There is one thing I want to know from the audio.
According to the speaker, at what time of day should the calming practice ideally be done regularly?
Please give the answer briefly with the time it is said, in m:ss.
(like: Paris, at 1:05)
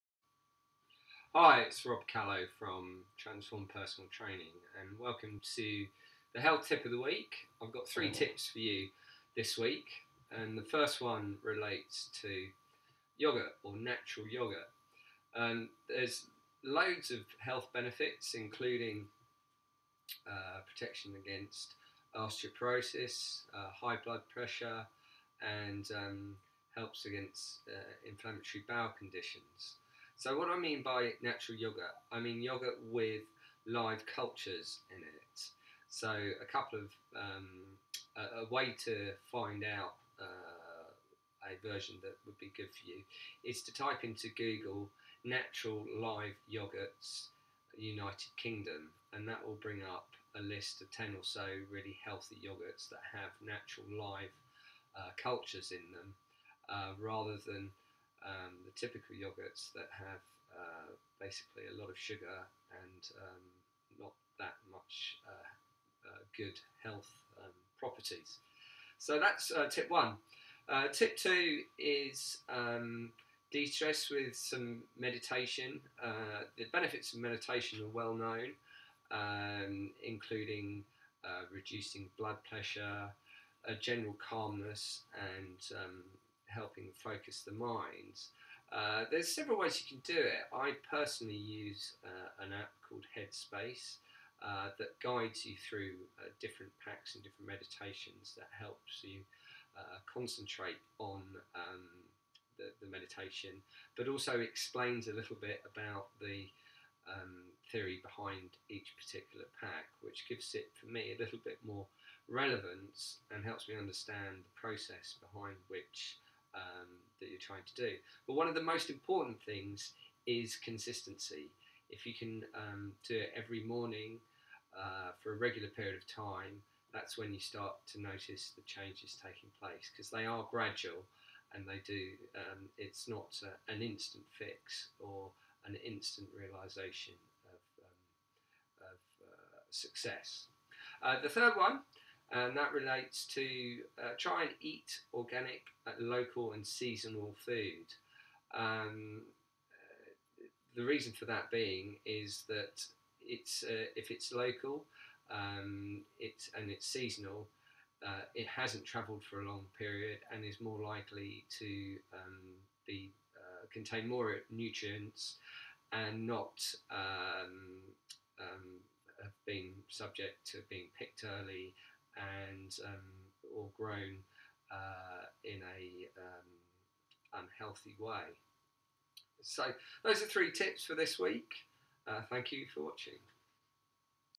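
Every morning, at 2:03.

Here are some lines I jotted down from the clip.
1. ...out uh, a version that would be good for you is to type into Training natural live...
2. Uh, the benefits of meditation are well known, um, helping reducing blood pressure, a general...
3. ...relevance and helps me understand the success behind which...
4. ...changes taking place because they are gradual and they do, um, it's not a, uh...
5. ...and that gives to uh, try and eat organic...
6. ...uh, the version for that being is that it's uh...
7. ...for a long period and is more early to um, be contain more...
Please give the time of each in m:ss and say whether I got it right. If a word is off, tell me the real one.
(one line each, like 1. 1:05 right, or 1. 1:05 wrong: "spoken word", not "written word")
1. 0:39 wrong: "Google", not "Training"
2. 1:16 wrong: "including", not "helping"
3. 1:52 wrong: "process", not "success"
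4. 2:08 right
5. 2:22 wrong: "relates", not "gives"
6. 2:29 wrong: "reason", not "version"
7. 2:39 wrong: "likely", not "early".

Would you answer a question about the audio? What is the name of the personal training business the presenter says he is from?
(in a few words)
Transform Personal Training.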